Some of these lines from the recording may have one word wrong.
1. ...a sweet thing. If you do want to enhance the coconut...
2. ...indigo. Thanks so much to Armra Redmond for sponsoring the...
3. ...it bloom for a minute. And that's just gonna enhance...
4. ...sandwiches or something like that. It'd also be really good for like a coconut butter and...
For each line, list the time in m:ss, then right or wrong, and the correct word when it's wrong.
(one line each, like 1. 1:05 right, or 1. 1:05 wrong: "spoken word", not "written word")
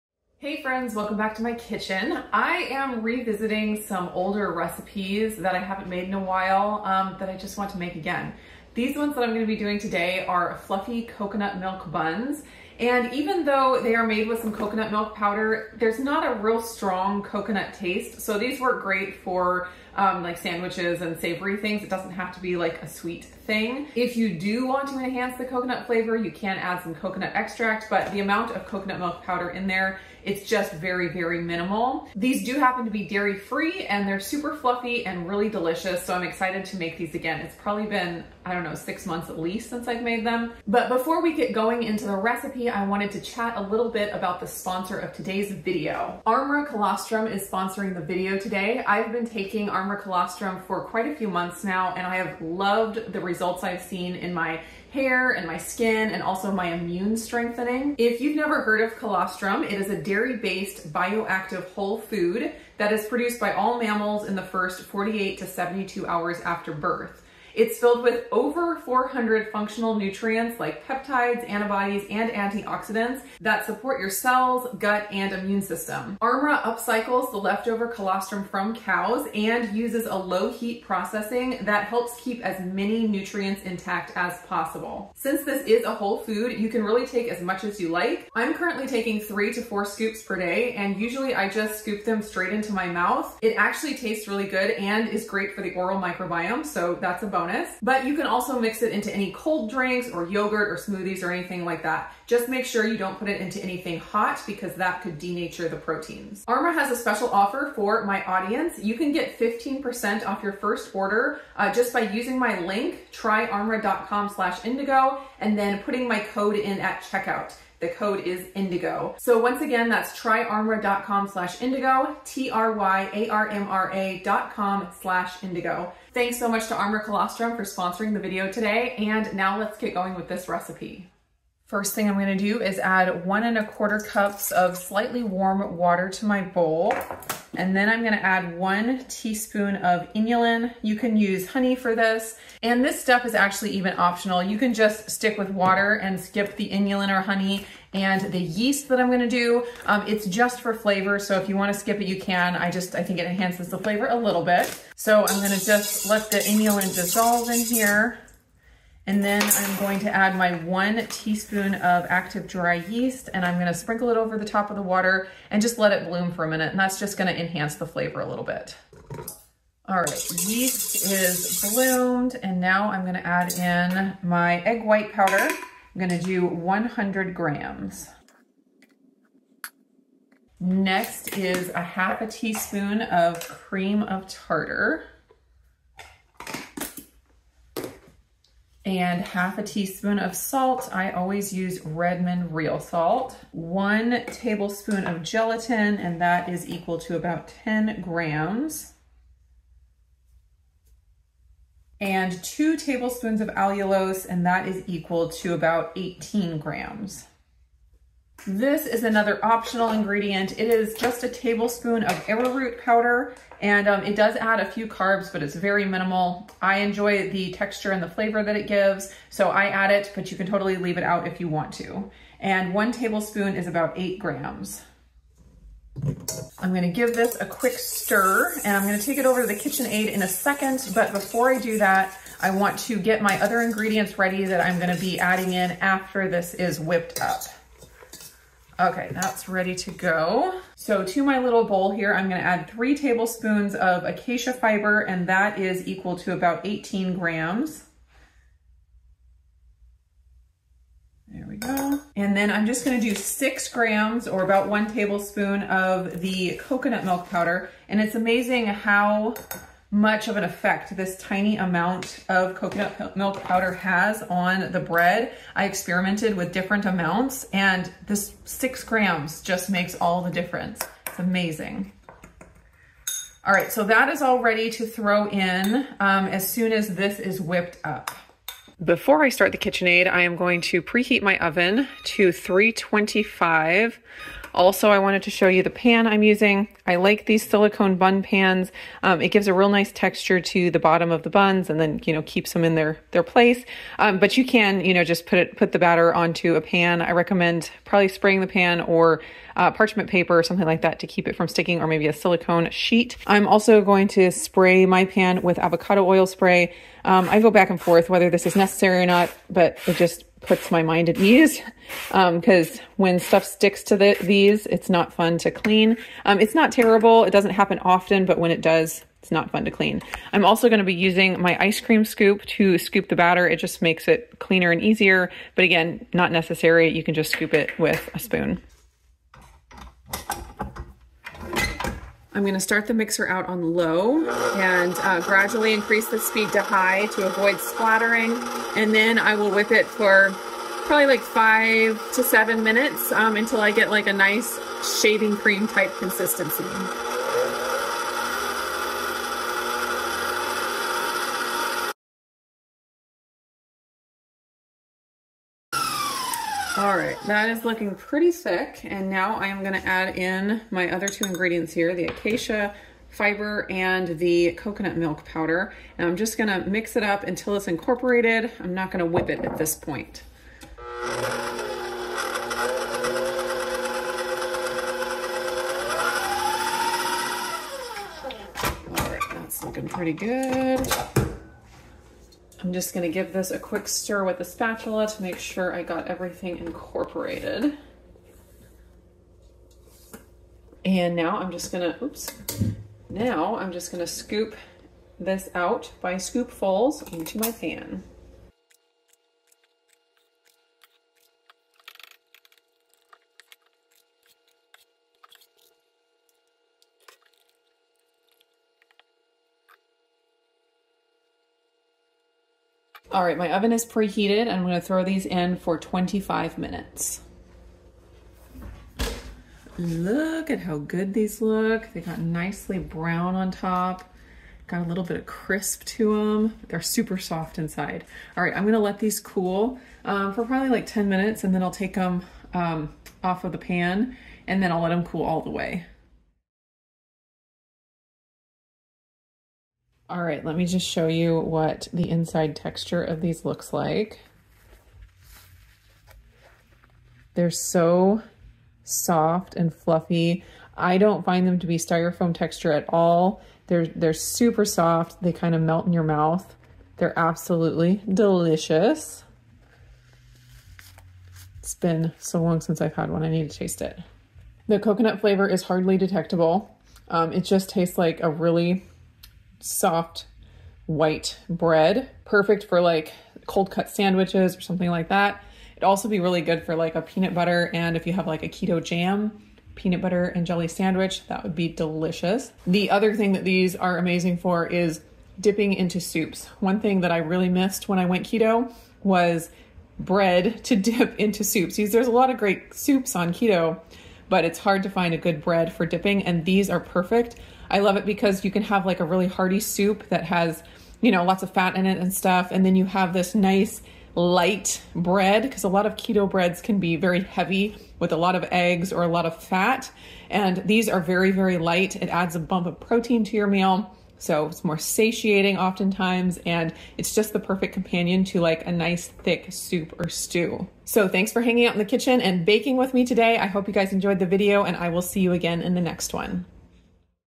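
1. 0:22 right
2. 2:05 wrong: "Colostrum", not "Redmond"
3. 2:45 right
4. 7:53 wrong: "peanut", not "coconut".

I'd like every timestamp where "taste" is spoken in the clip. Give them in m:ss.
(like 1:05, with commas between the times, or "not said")
0:17, 1:33, 7:43, 7:47.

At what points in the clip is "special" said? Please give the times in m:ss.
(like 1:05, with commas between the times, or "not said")
1:46.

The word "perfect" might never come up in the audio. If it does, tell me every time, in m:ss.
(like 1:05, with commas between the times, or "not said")
7:52, 8:16, 8:37.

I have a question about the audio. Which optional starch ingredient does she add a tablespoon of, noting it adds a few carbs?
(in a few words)
Arrowroot powder.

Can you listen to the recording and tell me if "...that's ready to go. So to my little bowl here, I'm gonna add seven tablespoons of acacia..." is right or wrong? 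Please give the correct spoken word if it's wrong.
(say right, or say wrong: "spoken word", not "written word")
wrong: "three", not "seven".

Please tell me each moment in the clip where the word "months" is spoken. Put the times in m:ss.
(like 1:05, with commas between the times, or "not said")
0:39, 0:51.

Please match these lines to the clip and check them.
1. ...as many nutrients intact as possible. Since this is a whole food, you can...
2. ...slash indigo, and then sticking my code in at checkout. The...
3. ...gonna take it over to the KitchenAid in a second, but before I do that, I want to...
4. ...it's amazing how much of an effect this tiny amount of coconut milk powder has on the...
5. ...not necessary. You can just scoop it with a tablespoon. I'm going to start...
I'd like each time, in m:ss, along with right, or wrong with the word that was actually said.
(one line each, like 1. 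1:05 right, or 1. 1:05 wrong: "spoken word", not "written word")
1. 1:22 right
2. 1:54 wrong: "putting", not "sticking"
3. 3:48 right
4. 4:18 right
5. 5:26 wrong: "spoon", not "tablespoon".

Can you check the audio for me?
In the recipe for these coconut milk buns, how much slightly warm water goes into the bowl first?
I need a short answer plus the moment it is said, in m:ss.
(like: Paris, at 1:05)
1 1/4 cups, at 2:13.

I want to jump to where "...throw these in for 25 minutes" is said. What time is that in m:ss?
6:54.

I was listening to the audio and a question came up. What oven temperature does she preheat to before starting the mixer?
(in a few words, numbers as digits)
325.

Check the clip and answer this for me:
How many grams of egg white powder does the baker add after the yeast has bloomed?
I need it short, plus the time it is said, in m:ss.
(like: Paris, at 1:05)
100 grams, at 2:56.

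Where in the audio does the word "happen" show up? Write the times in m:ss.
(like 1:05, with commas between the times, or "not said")
0:32, 5:17.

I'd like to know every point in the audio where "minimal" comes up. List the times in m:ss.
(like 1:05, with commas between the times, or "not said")
0:31, 3:35.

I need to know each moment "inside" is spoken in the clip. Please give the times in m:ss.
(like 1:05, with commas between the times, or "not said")
7:07, 7:22.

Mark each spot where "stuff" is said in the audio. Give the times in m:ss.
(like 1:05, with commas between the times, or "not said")
5:13, 8:22.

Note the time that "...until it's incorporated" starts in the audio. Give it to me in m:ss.
6:07.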